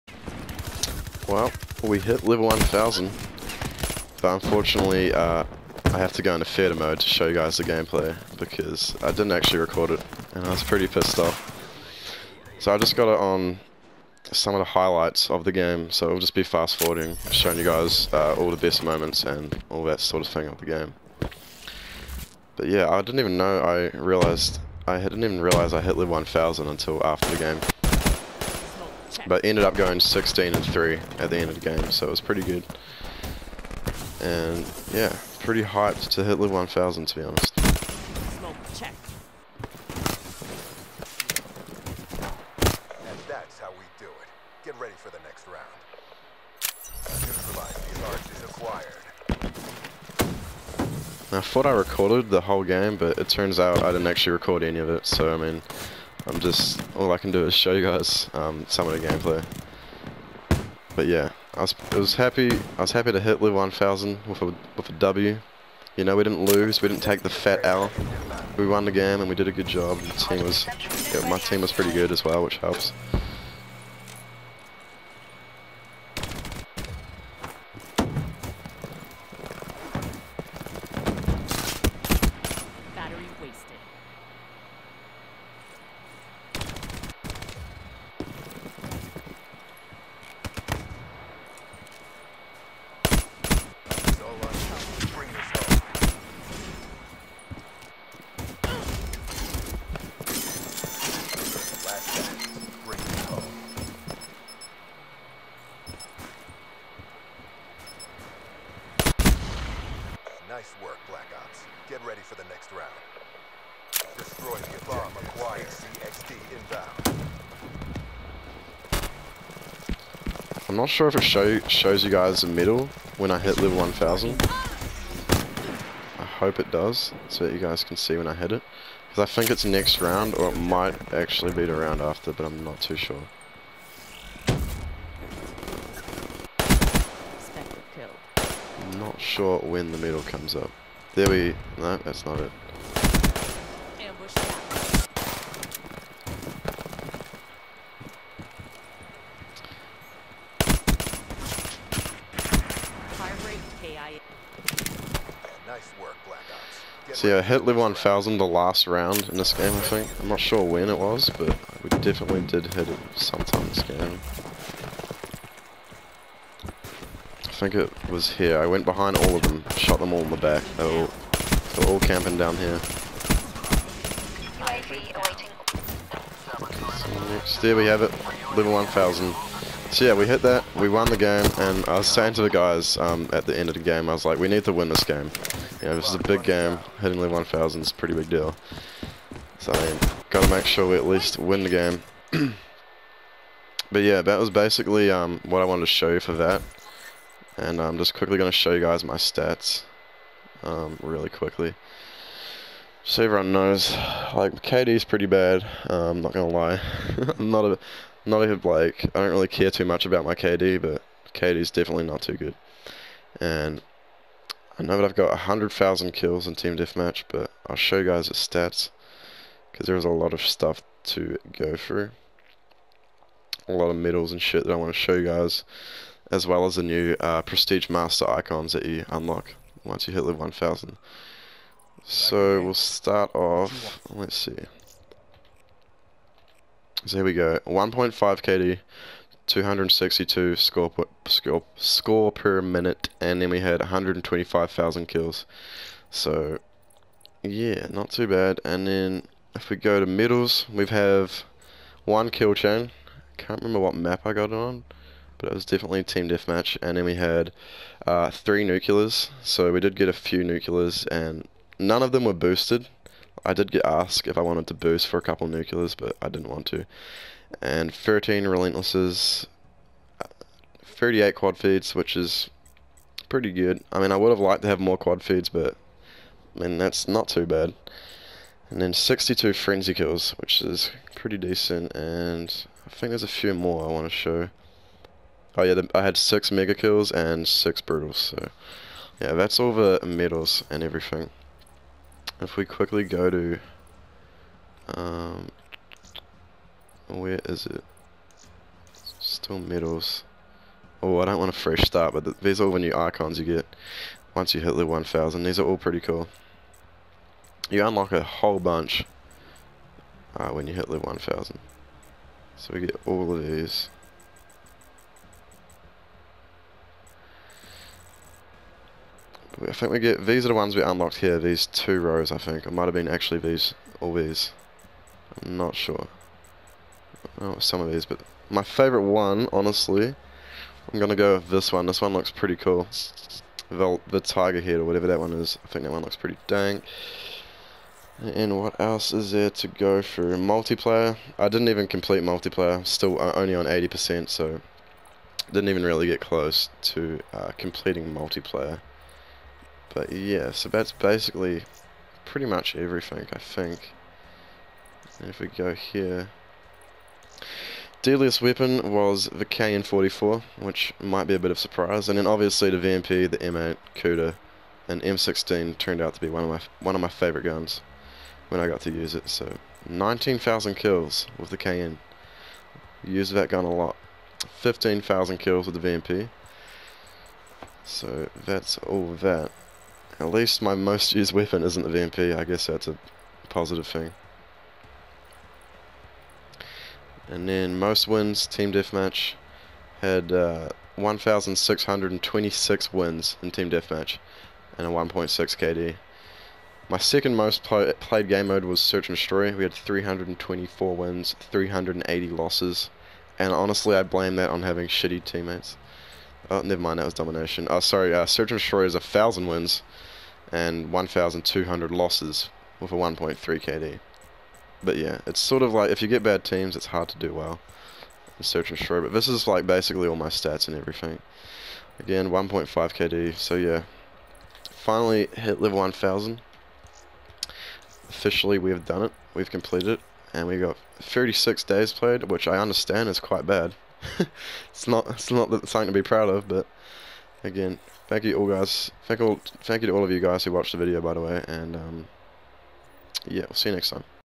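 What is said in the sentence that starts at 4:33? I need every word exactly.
I mean, I would have liked to have more quad feeds, but I mean that's not too bad.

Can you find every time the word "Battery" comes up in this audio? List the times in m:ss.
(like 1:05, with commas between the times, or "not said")
1:22.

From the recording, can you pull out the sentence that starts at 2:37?
So yeah, I hit level 1000 the last round in this game, I think.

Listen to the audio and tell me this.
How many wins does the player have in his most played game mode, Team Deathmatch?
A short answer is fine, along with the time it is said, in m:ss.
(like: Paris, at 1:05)
1,626, at 6:30.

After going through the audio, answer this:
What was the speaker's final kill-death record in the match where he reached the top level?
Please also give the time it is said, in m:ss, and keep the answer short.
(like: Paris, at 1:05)
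16 and 3, at 0:29.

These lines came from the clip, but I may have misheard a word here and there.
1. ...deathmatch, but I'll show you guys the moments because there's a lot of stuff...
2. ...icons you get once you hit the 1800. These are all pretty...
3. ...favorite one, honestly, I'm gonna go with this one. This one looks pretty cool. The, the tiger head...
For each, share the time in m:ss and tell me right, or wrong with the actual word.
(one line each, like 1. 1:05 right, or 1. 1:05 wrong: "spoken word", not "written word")
1. 3:36 wrong: "stats", not "moments"
2. 5:02 wrong: "1000", not "1800"
3. 5:28 right.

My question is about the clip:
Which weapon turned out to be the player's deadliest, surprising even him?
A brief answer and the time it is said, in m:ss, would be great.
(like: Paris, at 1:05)
KN-44, at 5:59.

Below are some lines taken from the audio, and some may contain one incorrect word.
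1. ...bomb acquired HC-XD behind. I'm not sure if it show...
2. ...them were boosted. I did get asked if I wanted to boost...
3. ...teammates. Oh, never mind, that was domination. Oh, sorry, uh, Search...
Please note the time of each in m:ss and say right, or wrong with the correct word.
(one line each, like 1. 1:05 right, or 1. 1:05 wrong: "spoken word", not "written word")
1. 1:54 wrong: "inbound", not "behind"
2. 4:22 right
3. 6:45 right.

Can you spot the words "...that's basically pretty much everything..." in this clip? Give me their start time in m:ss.
5:50.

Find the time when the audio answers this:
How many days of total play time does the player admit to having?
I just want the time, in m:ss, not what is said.
7:10.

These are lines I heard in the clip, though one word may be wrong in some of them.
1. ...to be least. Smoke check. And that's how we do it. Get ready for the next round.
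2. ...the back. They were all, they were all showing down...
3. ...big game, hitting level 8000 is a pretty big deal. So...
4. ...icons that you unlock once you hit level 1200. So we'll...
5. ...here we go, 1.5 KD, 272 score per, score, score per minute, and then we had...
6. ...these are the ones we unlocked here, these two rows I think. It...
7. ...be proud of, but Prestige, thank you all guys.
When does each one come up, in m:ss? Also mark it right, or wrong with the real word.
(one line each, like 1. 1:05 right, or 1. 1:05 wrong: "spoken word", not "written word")
1. 0:37 wrong: "honest", not "least"
2. 2:50 wrong: "camping", not "showing"
3. 3:06 wrong: "1000", not "8000"
4. 3:48 wrong: "1000", not "1200"
5. 3:57 wrong: "262", not "272"
6. 5:20 right
7. 7:15 wrong: "Again", not "Prestige".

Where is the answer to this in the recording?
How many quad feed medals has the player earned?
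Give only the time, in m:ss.
4:30.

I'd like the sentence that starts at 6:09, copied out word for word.
So 19,000 kills with the KN.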